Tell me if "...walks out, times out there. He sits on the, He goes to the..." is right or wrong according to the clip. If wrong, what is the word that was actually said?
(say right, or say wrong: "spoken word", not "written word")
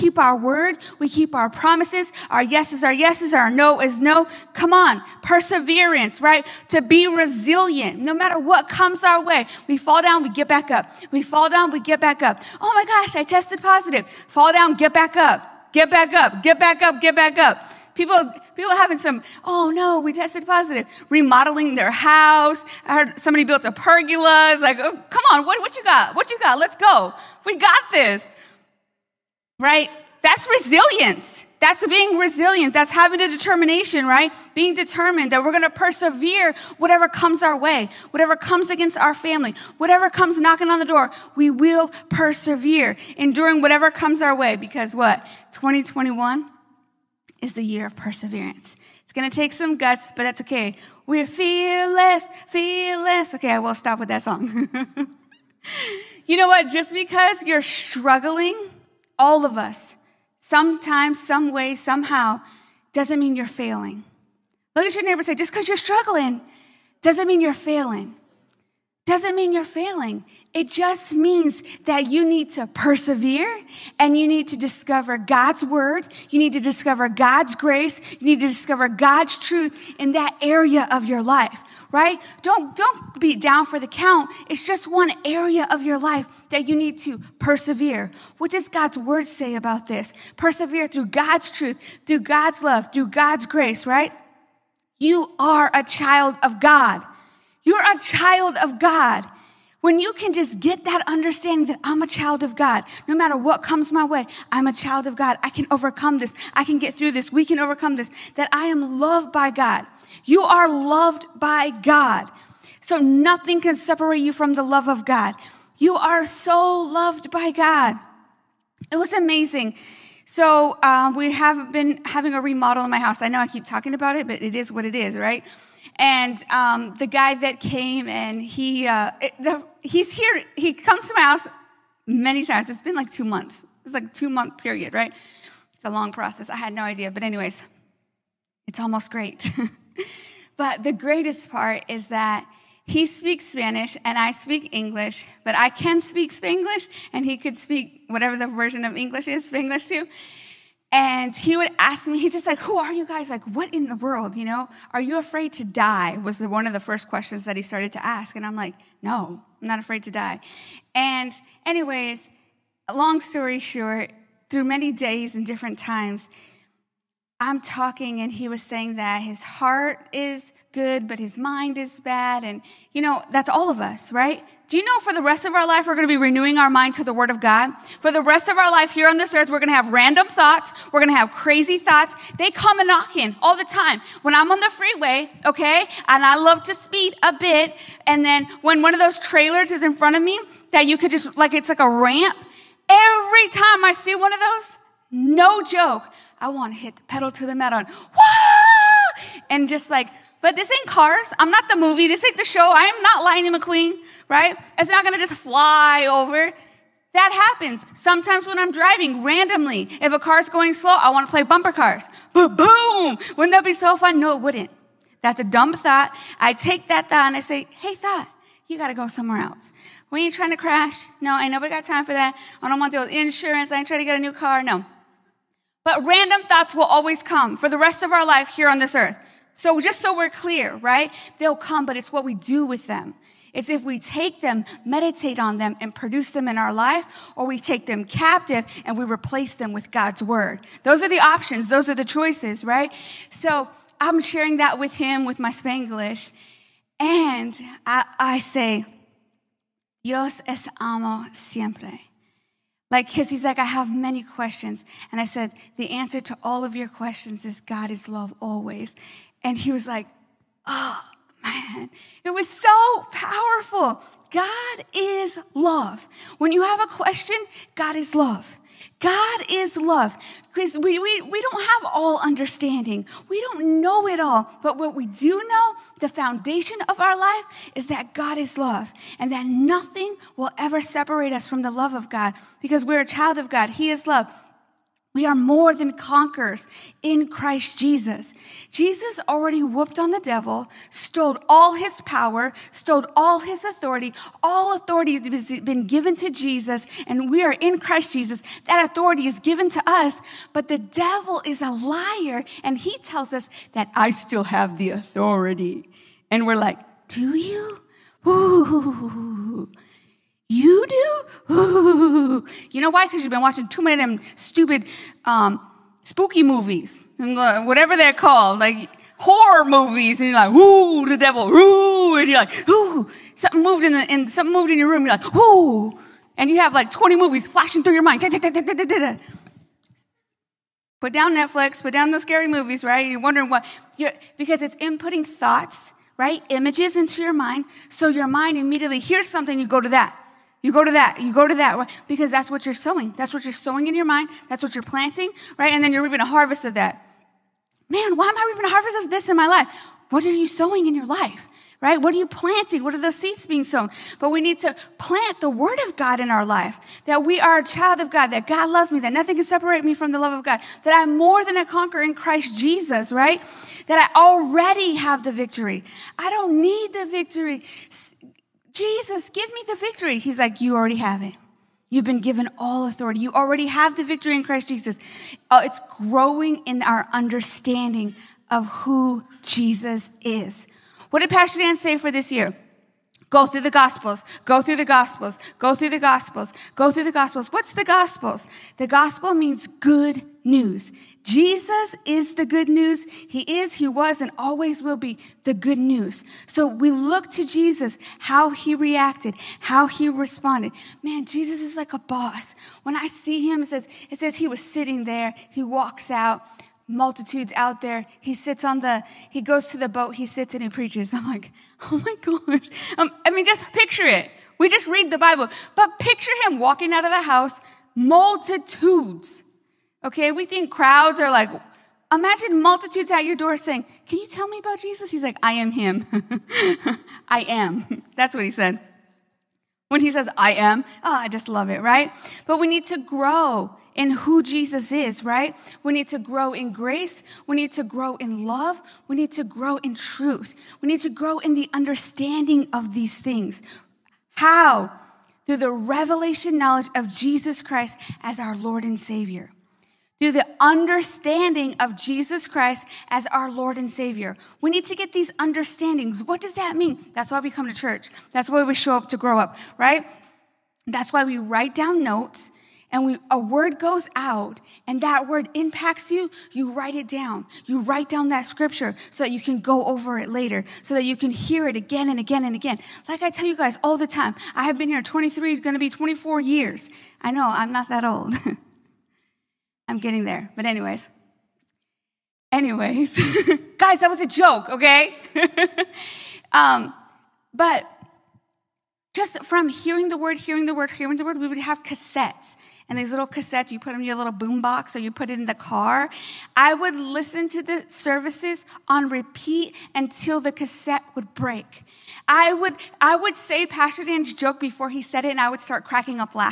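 wrong: "multitudes", not "times".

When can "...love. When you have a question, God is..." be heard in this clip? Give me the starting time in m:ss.
4:25.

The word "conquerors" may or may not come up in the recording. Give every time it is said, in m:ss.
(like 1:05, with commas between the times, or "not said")
4:45, 6:01.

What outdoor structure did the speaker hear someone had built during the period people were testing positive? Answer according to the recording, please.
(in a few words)
pergola.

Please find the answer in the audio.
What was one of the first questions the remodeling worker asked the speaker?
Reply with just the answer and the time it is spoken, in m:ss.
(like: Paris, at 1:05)
Are you afraid to die?, at 2:34.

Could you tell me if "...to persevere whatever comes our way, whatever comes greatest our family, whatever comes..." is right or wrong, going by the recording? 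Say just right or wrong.
wrong.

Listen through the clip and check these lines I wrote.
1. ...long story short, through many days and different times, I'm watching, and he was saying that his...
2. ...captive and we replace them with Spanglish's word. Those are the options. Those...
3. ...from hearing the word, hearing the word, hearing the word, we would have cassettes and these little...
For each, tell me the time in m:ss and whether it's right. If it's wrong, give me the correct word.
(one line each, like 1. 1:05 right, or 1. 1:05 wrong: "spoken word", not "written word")
1. 2:42 wrong: "talking", not "watching"
2. 3:58 wrong: "God", not "Spanglish"
3. 8:09 right.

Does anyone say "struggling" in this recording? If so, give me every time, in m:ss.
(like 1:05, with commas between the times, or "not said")
0:57, 1:05.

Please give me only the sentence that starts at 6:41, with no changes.
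Man, Jesus is like a boss.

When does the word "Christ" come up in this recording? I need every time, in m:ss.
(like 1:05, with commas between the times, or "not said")
4:47, 4:57, 6:02, 6:14, 7:27, 7:32.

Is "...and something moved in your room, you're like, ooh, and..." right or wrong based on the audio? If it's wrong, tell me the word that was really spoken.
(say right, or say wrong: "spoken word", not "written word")
right.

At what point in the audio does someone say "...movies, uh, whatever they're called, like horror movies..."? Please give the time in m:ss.
5:16.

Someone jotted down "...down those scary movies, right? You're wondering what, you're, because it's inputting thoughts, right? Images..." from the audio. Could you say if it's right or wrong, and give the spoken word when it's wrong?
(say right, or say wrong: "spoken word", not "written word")
right.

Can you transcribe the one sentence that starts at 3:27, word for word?
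Sometimes when I'm driving randomly, if a car's going slow, I wanna play bumper cars.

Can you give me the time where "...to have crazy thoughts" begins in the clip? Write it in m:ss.
3:01.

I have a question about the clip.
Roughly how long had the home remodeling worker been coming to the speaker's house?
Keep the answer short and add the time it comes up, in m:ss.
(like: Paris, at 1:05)
two months, at 2:13.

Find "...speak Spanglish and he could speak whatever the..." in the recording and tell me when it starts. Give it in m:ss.
2:25.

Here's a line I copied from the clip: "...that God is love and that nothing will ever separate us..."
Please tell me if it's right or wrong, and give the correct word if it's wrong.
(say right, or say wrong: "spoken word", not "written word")
right.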